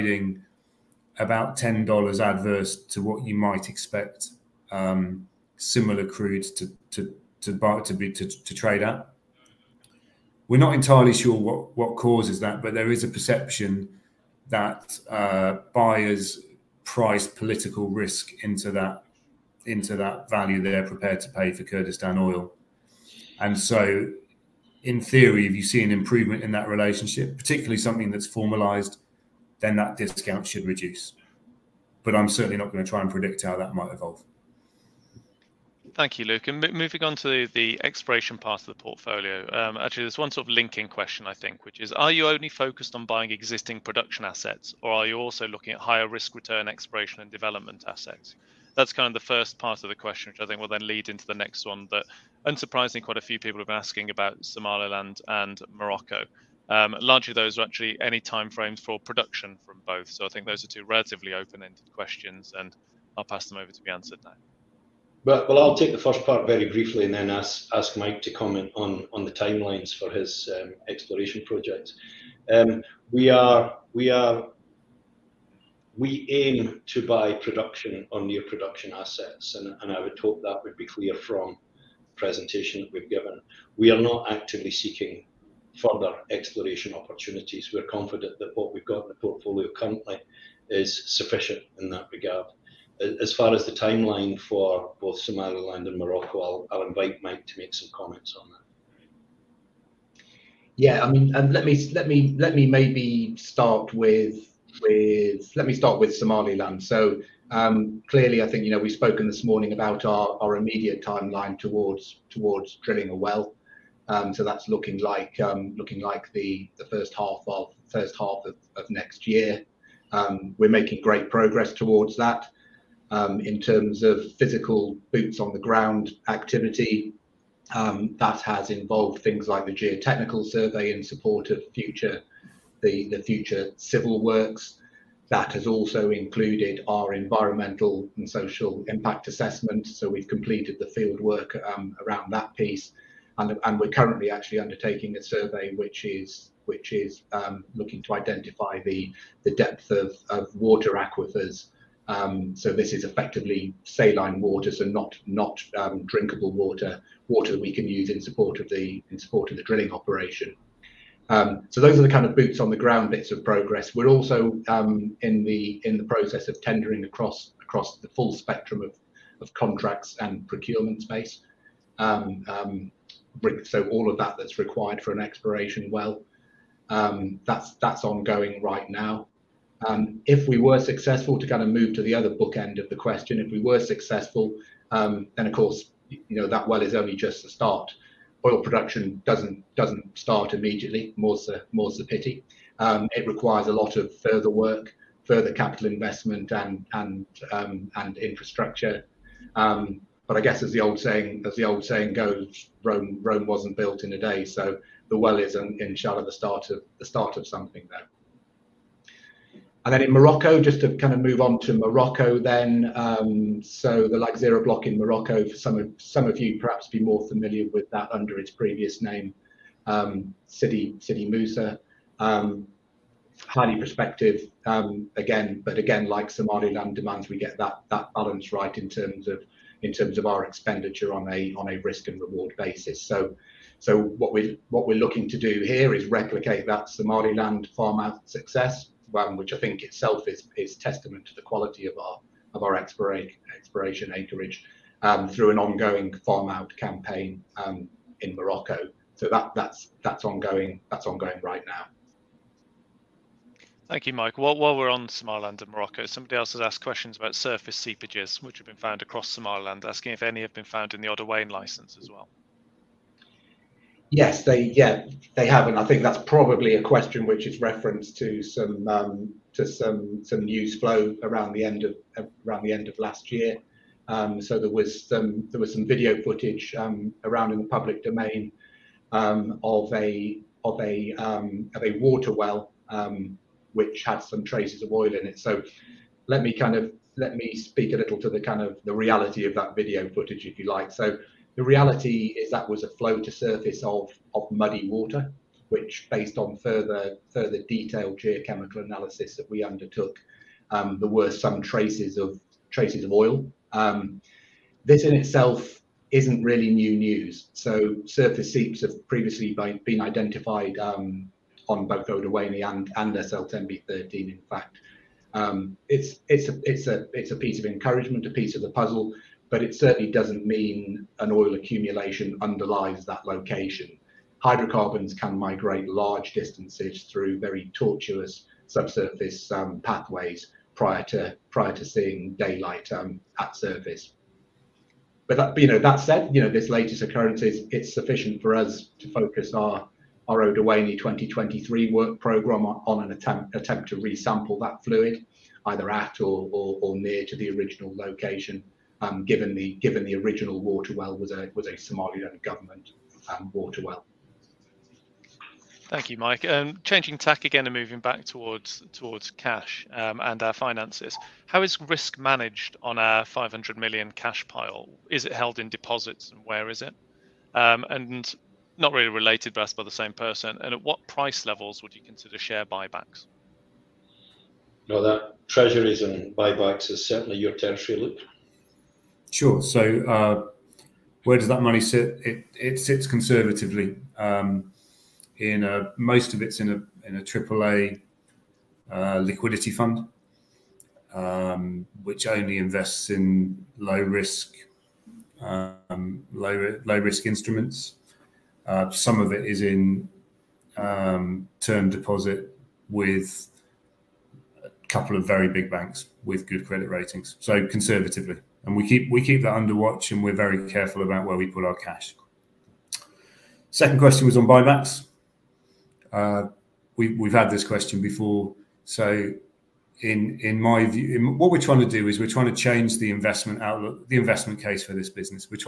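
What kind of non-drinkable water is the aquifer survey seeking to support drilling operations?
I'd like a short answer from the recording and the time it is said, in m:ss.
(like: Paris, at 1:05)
saline water, at 2:33.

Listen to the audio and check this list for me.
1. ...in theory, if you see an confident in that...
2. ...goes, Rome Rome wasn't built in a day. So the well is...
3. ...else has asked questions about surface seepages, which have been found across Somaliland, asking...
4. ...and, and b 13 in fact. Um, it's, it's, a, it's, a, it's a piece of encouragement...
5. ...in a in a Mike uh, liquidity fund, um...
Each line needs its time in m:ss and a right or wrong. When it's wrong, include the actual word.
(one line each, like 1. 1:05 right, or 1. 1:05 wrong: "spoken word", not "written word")
1. 0:24 wrong: "improvement", not "confident"
2. 3:22 right
3. 4:16 right
4. 5:12 right
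5. 6:26 wrong: "AAA", not "Mike".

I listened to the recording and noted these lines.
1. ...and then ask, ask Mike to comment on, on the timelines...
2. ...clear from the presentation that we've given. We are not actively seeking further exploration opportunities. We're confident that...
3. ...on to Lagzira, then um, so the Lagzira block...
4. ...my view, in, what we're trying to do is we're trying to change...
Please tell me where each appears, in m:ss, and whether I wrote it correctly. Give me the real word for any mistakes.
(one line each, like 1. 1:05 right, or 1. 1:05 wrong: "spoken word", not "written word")
1. 1:07 right
2. 1:20 right
3. 3:31 wrong: "Morocco", not "Lagzira"
4. 7:00 right.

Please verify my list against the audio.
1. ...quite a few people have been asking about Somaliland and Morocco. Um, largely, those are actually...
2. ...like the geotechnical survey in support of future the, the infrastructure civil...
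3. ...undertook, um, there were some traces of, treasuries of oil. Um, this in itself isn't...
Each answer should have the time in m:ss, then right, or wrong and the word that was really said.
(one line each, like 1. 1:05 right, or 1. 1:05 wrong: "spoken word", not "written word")
1. 0:53 right
2. 2:09 wrong: "future", not "infrastructure"
3. 4:59 wrong: "traces", not "treasuries".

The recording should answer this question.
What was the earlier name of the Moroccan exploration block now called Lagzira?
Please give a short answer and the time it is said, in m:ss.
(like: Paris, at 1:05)
Sidi Moussa, at 3:40.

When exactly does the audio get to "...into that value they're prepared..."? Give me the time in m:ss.
0:19.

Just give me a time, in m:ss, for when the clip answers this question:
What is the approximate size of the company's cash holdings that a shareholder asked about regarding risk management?
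6:03.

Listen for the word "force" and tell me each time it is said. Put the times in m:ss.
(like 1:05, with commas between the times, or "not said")
not said.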